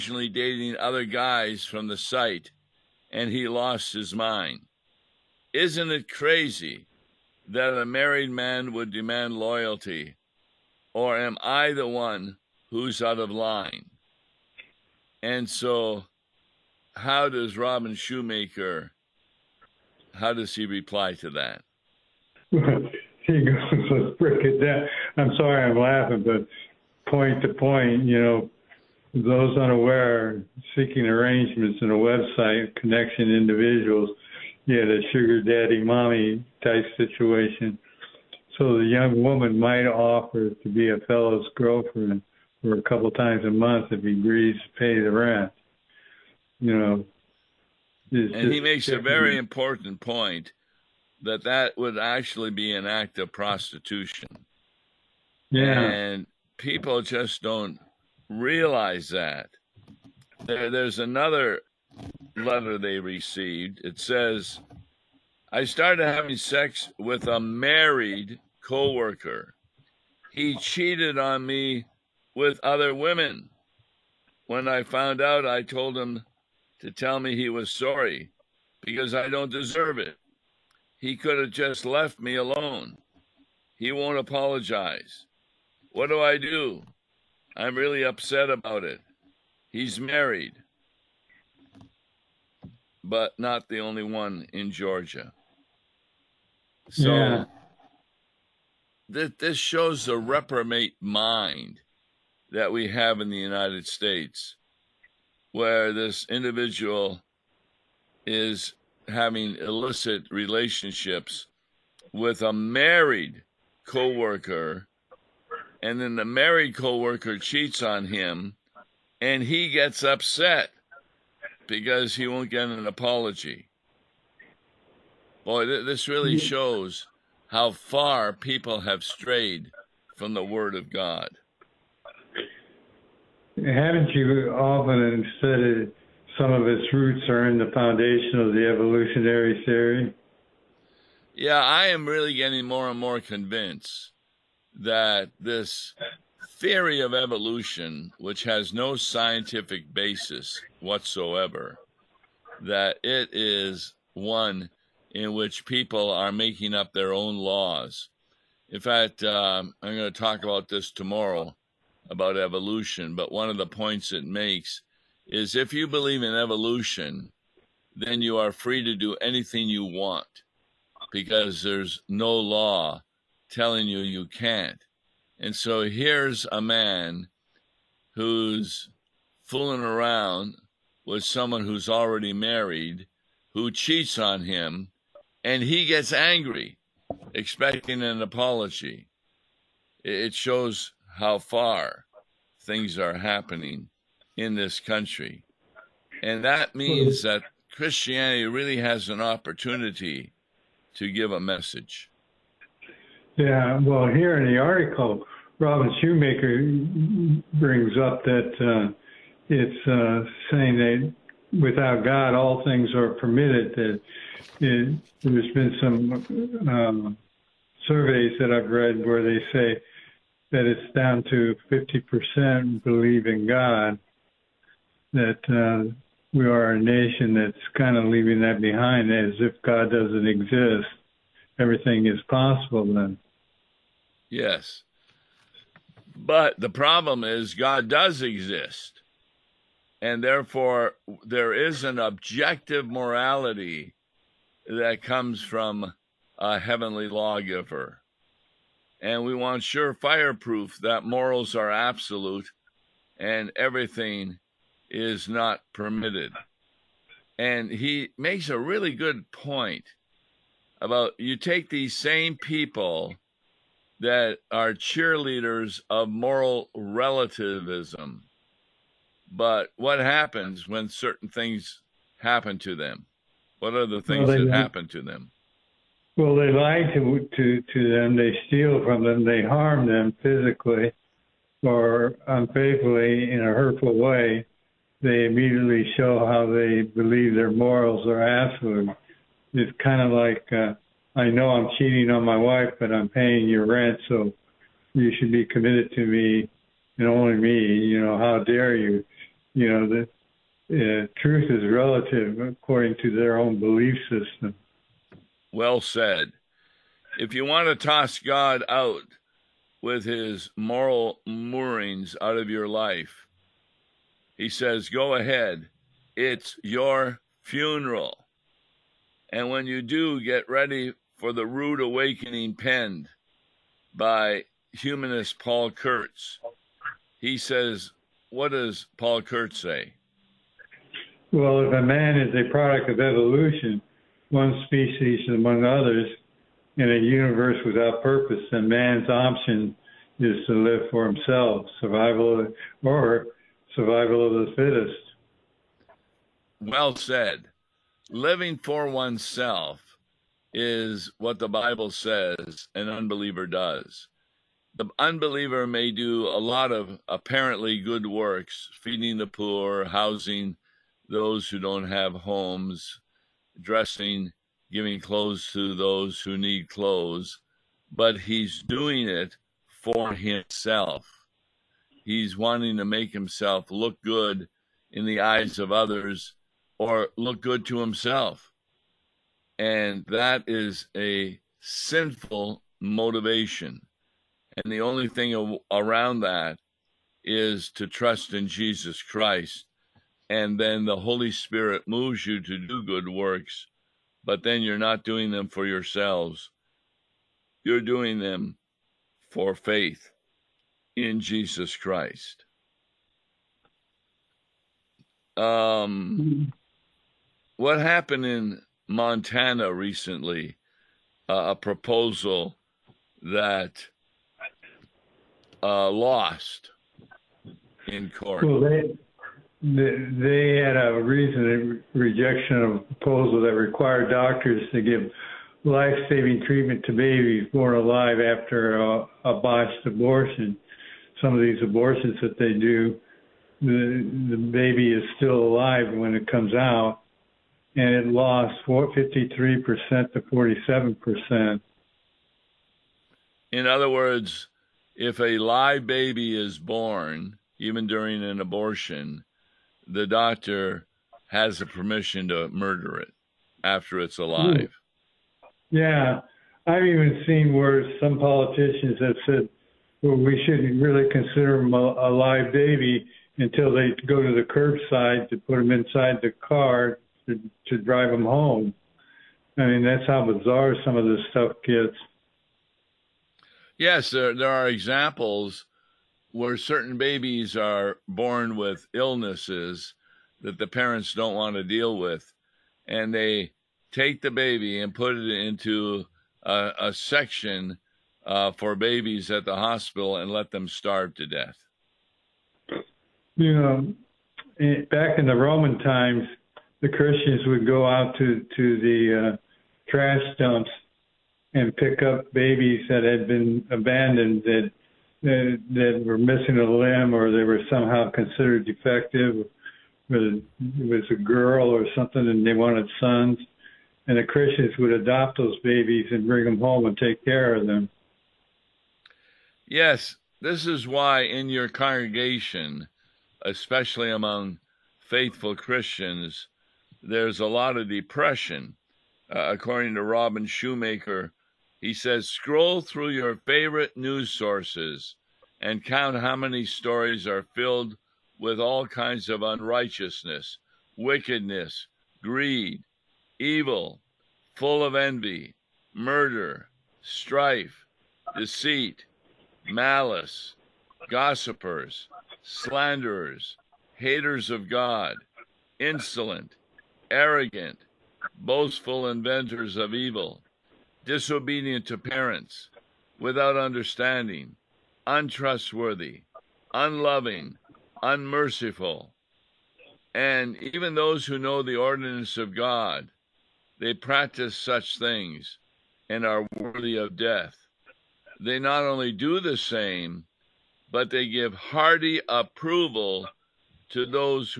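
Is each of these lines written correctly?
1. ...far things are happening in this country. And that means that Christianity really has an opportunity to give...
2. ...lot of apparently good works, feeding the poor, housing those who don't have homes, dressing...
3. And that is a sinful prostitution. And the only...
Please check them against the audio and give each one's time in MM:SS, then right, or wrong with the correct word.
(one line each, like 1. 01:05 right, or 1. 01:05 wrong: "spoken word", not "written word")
1. 03:11 right
2. 05:56 right
3. 06:19 wrong: "motivation", not "prostitution".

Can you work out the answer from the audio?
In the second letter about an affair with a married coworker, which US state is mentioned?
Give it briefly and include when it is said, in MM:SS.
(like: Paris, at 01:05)
Georgia, at 01:34.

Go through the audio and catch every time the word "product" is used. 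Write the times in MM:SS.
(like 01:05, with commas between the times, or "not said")
05:32.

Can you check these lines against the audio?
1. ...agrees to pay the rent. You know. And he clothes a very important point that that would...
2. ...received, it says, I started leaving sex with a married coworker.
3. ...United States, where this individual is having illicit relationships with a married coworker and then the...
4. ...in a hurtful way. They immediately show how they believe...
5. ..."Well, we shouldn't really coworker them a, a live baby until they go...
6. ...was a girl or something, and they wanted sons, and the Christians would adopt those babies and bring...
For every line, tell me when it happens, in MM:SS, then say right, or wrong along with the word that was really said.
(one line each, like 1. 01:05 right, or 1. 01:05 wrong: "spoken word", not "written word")
1. 00:44 wrong: "makes", not "clothes"
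2. 01:02 wrong: "having", not "leaving"
3. 01:43 right
4. 04:43 right
5. 07:40 wrong: "consider", not "coworker"
6. 08:30 right.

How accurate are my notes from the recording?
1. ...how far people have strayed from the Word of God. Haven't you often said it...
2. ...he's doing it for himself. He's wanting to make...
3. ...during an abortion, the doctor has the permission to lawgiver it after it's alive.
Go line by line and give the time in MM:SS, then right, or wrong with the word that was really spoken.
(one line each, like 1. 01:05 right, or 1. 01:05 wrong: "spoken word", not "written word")
1. 02:07 right
2. 06:08 right
3. 07:27 wrong: "murder", not "lawgiver".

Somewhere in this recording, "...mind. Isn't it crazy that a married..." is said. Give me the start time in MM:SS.
00:04.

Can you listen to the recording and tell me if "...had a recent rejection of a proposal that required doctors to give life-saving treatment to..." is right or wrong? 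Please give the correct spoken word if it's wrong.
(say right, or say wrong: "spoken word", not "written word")
right.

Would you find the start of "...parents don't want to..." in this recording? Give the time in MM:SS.
08:00.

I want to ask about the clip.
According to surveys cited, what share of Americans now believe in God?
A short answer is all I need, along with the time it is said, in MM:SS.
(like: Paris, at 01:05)
50%, at 03:41.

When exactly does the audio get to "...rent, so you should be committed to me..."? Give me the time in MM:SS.
04:53.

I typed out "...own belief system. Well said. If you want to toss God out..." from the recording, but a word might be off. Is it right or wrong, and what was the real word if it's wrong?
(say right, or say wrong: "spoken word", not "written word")
right.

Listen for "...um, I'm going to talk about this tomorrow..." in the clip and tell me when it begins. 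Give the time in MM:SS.
02:39.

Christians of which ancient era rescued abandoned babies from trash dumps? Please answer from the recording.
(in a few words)
Roman times.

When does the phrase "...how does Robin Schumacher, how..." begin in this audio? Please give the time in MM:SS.
00:16.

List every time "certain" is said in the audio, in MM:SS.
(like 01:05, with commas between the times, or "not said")
04:30, 07:56.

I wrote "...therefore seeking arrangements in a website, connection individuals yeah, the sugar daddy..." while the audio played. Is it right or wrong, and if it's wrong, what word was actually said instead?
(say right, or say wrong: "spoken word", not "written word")
wrong: "unaware", not "therefore".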